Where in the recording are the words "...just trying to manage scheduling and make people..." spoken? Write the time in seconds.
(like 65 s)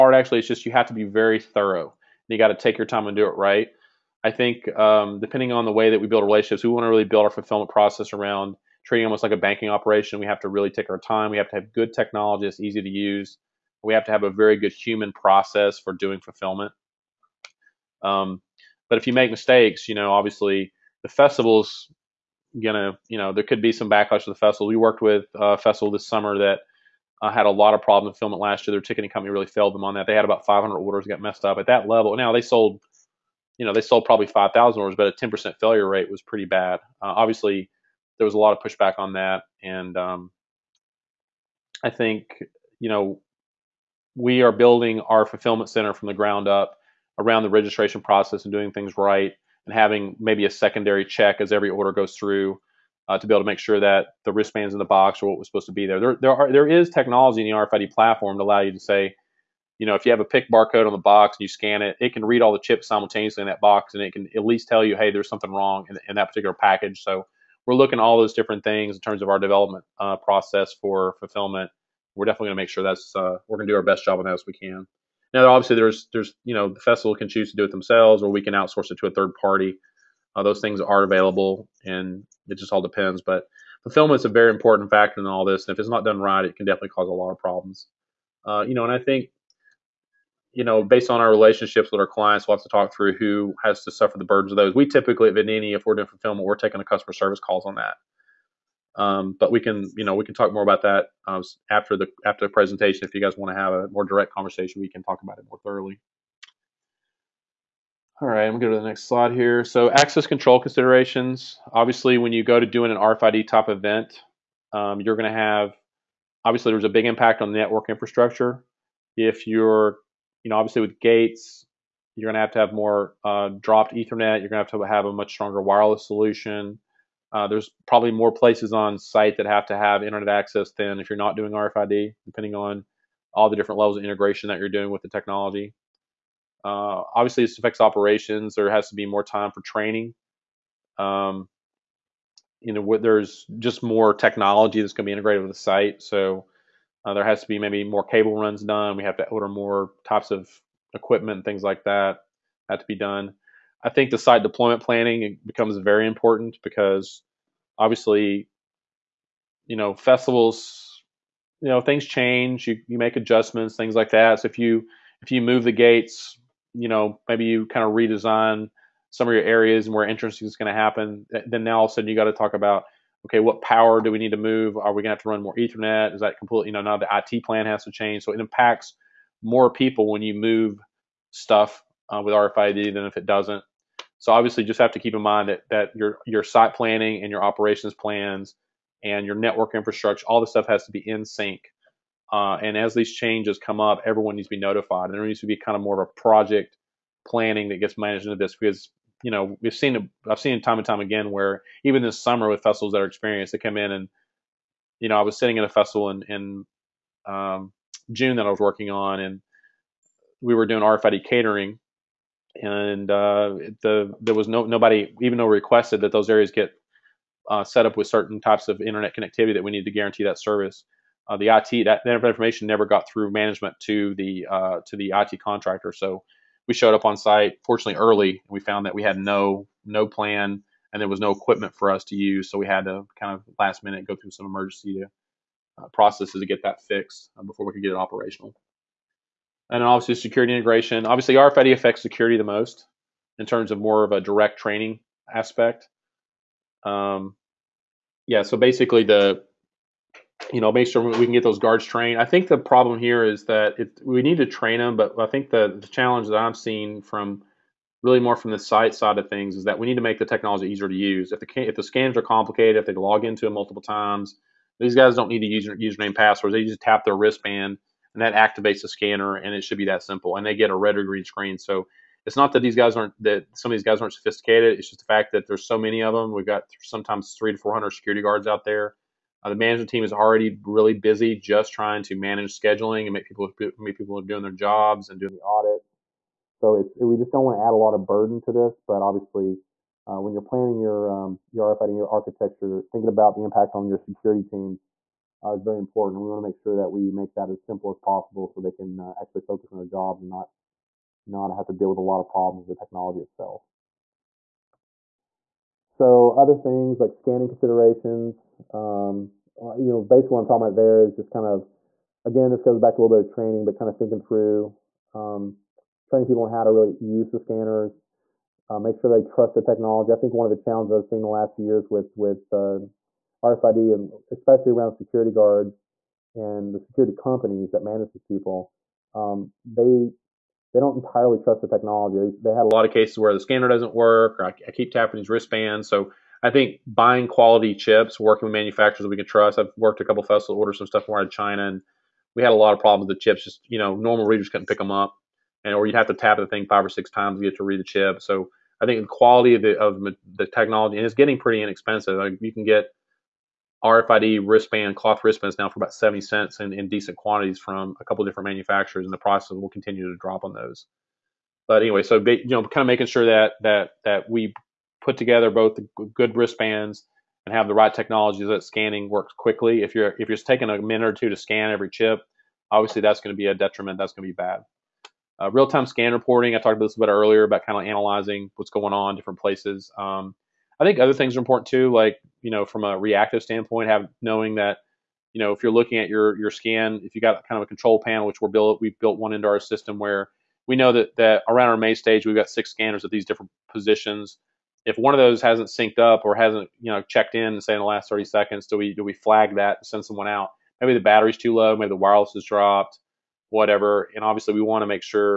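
281 s.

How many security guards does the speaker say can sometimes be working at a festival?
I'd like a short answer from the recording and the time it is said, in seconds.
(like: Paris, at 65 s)
300 to 400, at 277 s.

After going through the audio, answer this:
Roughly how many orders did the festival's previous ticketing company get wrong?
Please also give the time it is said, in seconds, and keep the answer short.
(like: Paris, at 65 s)
500, at 30 s.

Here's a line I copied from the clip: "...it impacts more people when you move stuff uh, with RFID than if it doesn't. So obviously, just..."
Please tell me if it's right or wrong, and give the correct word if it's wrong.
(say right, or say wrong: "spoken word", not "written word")
right.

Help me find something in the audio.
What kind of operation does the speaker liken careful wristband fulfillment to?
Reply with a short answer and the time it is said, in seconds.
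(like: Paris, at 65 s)
banking operation, at 9 s.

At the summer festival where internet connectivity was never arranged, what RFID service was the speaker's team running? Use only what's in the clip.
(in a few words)
RFID catering.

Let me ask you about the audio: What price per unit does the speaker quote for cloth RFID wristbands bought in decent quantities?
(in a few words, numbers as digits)
70 cents.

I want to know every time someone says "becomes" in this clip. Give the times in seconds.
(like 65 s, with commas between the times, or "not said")
155 s.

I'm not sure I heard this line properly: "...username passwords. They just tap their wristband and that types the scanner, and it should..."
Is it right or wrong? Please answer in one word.
wrong.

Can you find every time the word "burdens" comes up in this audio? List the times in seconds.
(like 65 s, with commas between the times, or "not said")
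94 s, 288 s.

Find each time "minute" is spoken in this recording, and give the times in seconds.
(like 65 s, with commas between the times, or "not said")
233 s, 370 s.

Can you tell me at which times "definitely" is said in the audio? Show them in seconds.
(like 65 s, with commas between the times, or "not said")
72 s, 86 s.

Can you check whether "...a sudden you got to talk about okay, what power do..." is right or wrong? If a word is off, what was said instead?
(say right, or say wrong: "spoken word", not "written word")
right.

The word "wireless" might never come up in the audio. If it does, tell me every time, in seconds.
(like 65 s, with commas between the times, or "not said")
125 s, 401 s.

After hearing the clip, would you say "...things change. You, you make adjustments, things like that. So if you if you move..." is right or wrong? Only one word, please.
right.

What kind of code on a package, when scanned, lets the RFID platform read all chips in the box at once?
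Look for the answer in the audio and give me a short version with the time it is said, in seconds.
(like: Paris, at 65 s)
pick barcode, at 60 s.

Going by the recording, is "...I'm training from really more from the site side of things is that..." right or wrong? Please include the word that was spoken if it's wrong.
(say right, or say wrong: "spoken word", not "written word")
wrong: "seeing", not "training".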